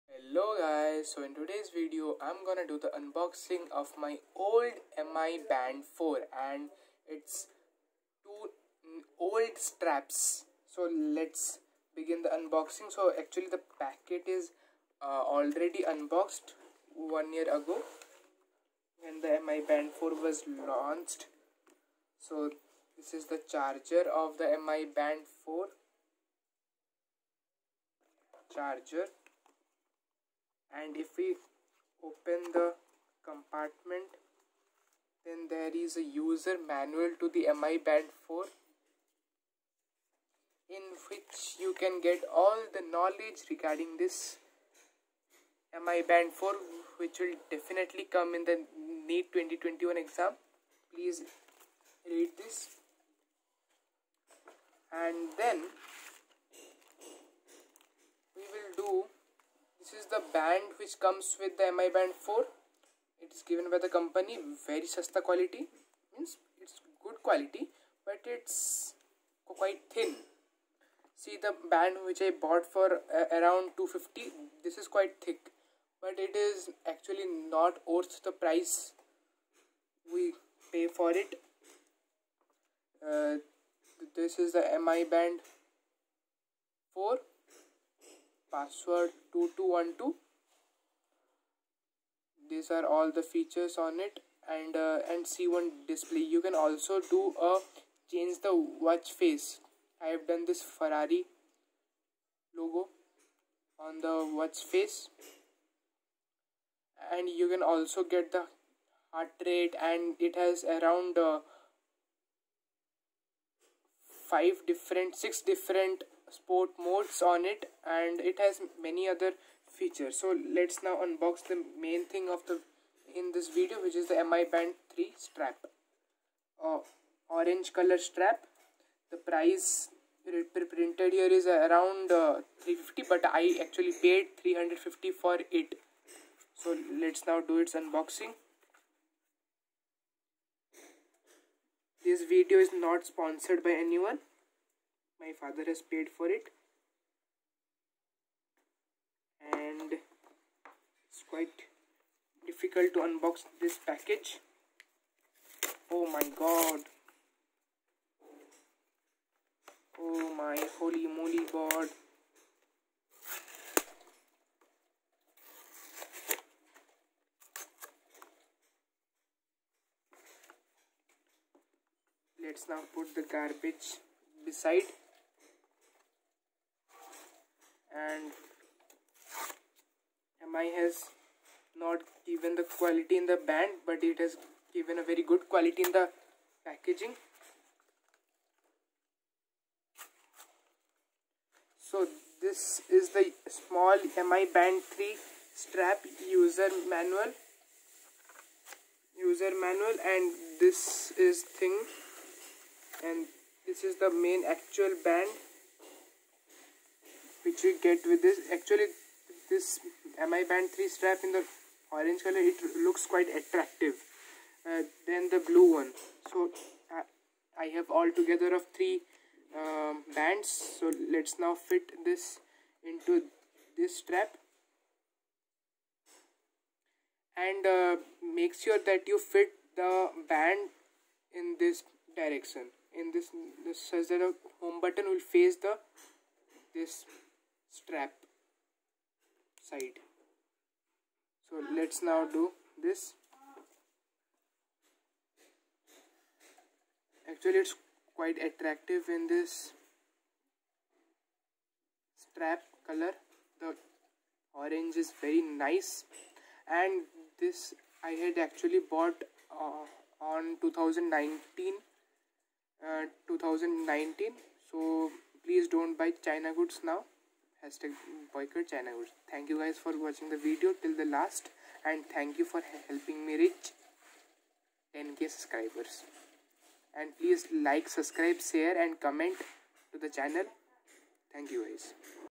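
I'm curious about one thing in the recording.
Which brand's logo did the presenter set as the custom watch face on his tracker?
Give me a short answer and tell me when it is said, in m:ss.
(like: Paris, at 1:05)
Ferrari, at 1:40.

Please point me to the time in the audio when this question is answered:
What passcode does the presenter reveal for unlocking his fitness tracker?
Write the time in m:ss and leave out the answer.
1:28.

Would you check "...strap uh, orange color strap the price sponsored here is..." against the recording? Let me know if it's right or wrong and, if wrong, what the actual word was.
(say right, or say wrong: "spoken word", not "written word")
wrong: "printed", not "sponsored".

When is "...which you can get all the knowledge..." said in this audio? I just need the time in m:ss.
0:41.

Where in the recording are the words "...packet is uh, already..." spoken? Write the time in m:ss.
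0:13.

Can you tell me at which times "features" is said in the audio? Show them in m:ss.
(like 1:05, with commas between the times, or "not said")
1:33, 1:59.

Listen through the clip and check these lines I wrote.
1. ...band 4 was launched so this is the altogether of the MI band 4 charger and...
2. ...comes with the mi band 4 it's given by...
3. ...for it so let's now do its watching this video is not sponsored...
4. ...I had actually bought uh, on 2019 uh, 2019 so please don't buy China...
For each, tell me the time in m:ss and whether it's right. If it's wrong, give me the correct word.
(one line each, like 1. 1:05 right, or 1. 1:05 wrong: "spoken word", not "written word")
1. 0:19 wrong: "charger", not "altogether"
2. 1:00 right
3. 2:15 wrong: "unboxing", not "watching"
4. 4:18 right.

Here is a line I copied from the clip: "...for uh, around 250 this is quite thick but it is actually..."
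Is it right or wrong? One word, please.
right.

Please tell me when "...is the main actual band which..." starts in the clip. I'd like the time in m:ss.
3:23.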